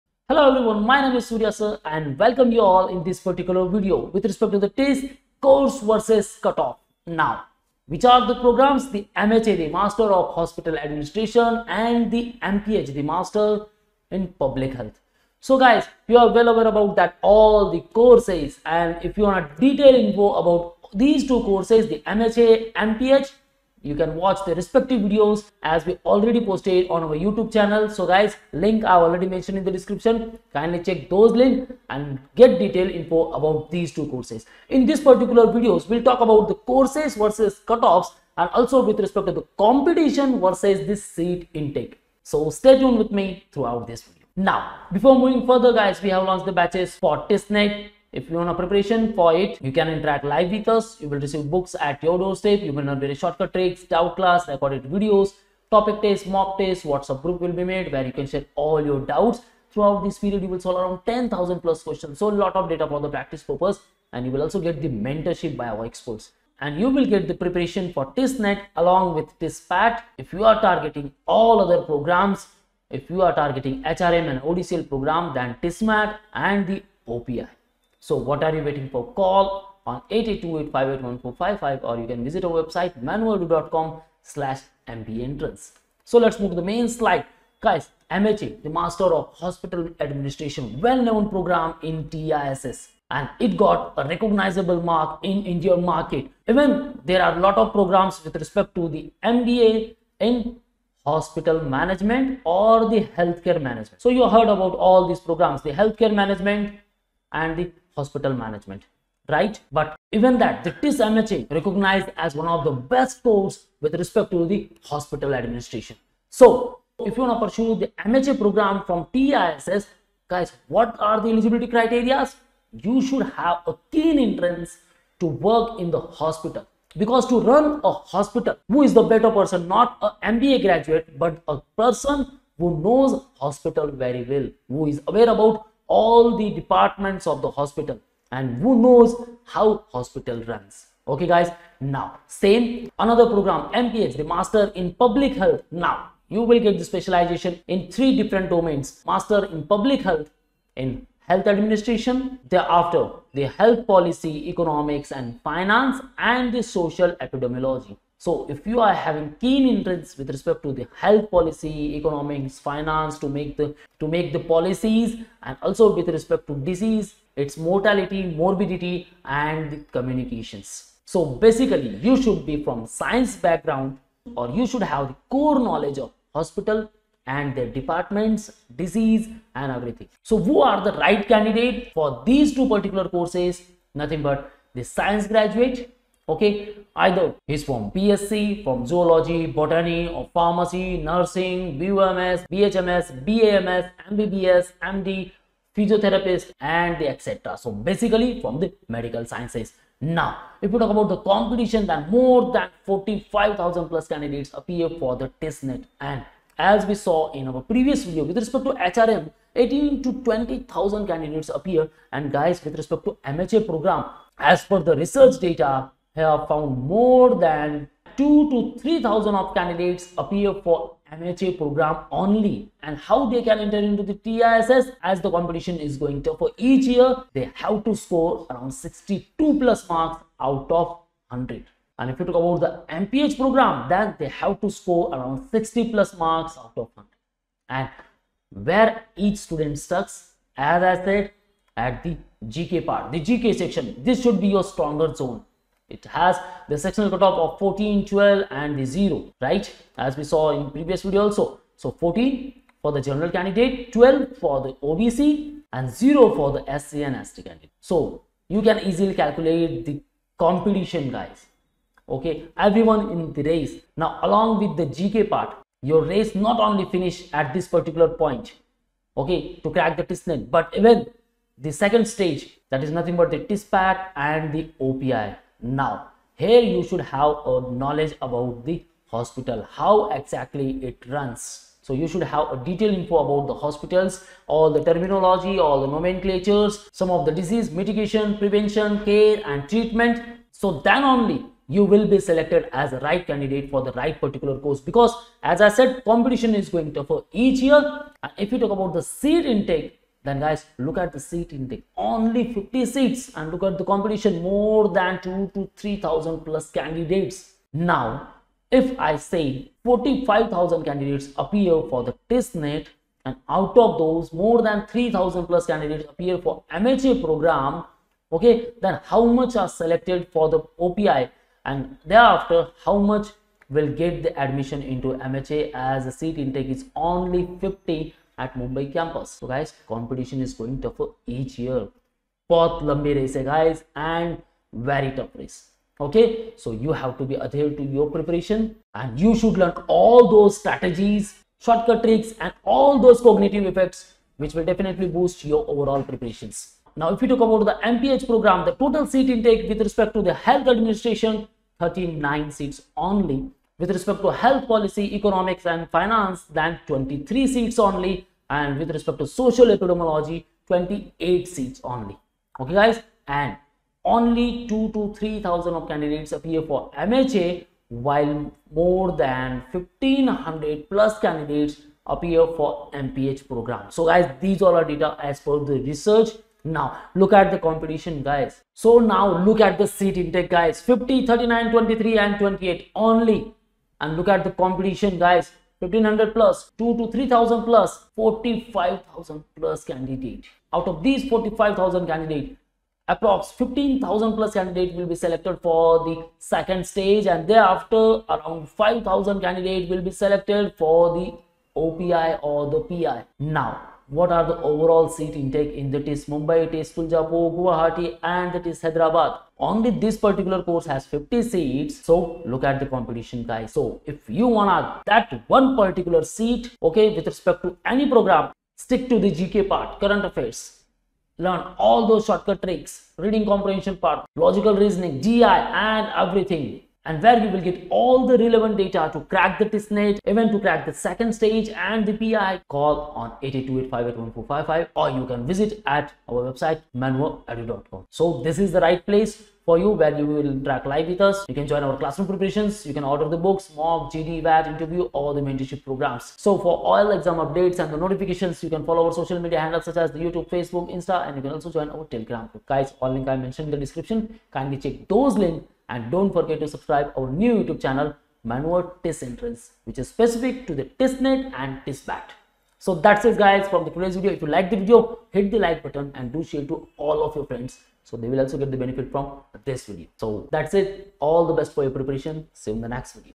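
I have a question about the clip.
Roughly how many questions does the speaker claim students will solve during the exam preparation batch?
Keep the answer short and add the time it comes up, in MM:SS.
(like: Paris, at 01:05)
10,000 plus, at 01:01.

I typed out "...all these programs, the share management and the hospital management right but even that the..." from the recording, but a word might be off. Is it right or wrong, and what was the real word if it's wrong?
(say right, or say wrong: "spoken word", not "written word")
wrong: "healthcare", not "share".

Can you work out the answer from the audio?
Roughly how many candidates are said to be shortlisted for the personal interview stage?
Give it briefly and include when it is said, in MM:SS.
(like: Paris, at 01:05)
5000, at 06:38.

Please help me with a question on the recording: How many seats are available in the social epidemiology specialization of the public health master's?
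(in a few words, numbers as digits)
28.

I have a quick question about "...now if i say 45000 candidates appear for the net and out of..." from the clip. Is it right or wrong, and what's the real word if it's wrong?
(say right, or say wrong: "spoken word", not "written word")
right.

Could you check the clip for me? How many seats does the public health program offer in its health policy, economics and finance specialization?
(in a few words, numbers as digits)
23.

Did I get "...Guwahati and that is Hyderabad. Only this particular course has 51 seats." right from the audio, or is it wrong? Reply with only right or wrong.
wrong.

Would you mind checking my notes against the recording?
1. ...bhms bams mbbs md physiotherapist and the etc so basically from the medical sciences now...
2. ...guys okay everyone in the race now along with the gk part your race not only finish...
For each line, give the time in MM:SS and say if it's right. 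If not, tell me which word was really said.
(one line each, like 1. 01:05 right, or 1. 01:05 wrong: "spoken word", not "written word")
1. 03:12 right
2. 04:21 right.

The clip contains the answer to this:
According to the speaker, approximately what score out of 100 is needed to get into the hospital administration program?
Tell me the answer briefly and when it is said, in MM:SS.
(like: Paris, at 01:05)
62 plus, at 03:48.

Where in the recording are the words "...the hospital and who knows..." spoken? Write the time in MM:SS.
02:17.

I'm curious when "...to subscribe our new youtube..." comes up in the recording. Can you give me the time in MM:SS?
07:36.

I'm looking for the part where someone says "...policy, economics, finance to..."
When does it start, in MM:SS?
02:41.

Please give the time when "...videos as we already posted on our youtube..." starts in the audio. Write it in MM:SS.
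00:25.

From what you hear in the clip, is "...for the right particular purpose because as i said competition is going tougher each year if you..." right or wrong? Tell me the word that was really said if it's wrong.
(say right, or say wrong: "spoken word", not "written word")
wrong: "course", not "purpose".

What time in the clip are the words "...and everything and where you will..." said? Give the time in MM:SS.
07:05.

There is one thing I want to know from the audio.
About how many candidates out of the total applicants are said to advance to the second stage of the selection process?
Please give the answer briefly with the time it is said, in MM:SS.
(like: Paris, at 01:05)
15000 plus, at 06:33.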